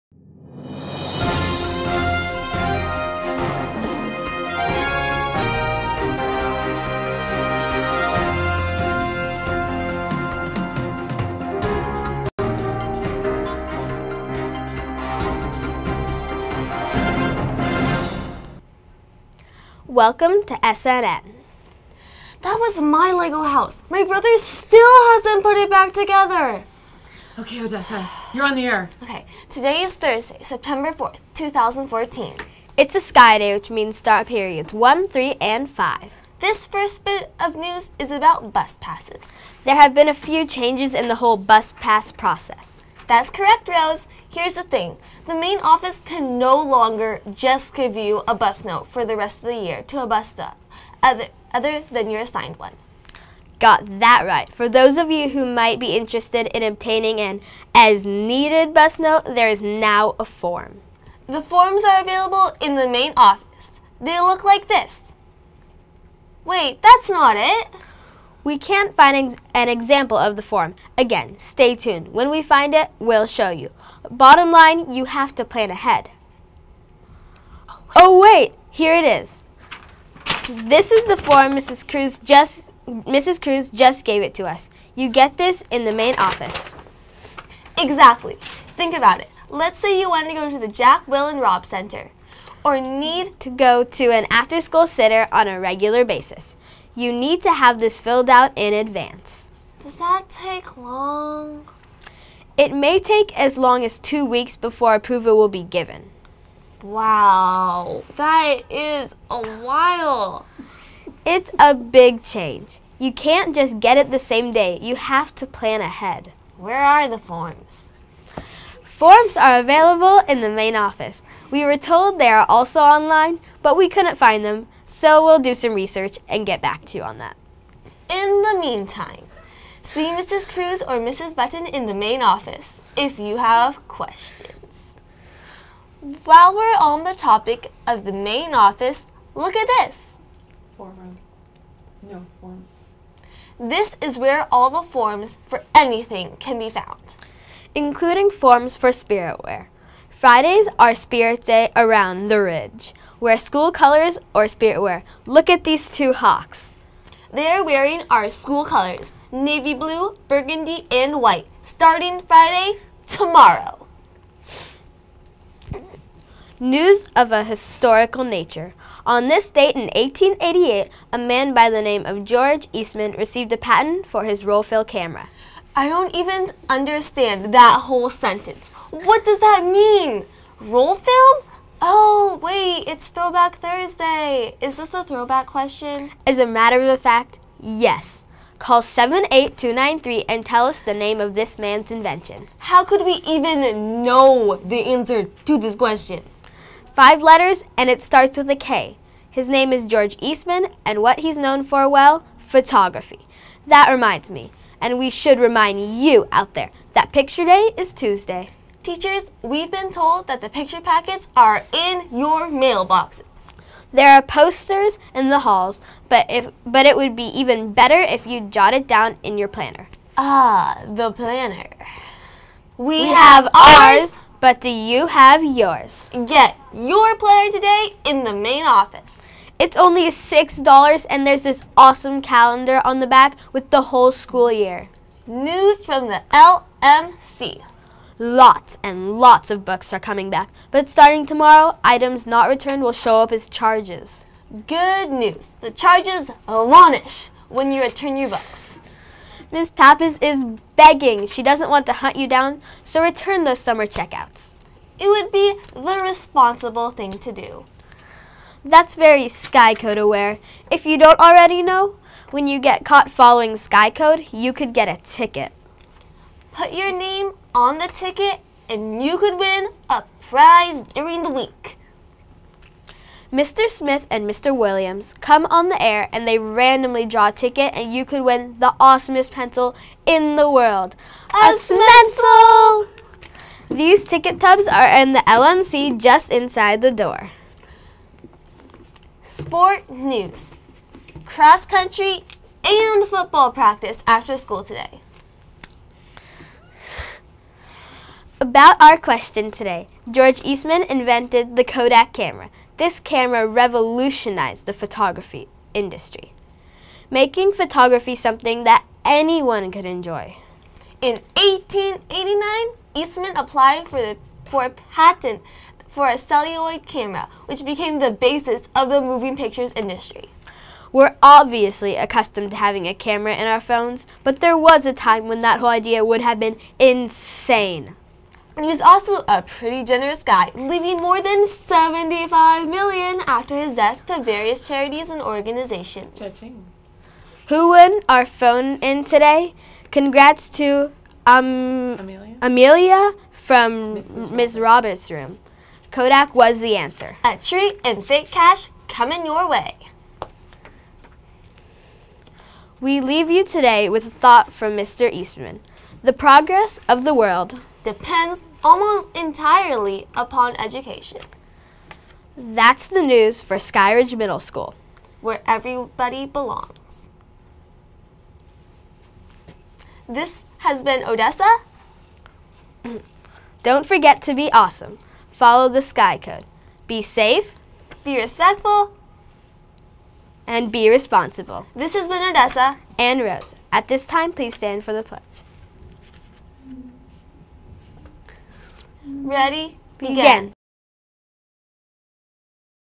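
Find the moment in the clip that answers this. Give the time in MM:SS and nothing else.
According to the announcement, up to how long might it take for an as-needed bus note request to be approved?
01:43.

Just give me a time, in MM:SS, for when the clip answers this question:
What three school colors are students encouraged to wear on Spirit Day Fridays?
02:39.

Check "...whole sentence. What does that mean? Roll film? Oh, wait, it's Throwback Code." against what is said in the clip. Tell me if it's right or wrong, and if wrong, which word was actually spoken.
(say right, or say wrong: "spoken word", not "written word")
wrong: "Thursday", not "Code".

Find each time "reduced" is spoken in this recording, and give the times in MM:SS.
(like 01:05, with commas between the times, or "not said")
not said.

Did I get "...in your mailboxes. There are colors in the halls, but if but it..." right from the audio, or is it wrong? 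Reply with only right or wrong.
wrong.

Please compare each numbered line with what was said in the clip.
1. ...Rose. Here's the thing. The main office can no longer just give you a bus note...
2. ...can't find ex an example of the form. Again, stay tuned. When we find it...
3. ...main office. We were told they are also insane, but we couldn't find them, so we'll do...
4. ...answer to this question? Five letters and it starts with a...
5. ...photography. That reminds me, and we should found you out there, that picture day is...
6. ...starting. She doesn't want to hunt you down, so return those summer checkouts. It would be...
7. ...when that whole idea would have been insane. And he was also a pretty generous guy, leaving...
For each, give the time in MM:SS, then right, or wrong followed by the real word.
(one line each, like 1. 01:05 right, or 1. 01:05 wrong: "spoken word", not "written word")
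1. 00:43 right
2. 01:08 right
3. 02:00 wrong: "online", not "insane"
4. 03:14 right
5. 03:22 wrong: "remind", not "found"
6. 04:10 wrong: "begging", not "starting"
7. 05:25 right.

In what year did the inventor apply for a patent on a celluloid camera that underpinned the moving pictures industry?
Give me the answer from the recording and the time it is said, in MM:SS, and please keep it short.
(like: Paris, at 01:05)
1889, at 05:11.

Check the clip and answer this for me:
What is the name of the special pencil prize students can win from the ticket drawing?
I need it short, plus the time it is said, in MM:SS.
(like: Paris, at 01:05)
Smencil, at 04:41.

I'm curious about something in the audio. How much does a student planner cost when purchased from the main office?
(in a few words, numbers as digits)
$6.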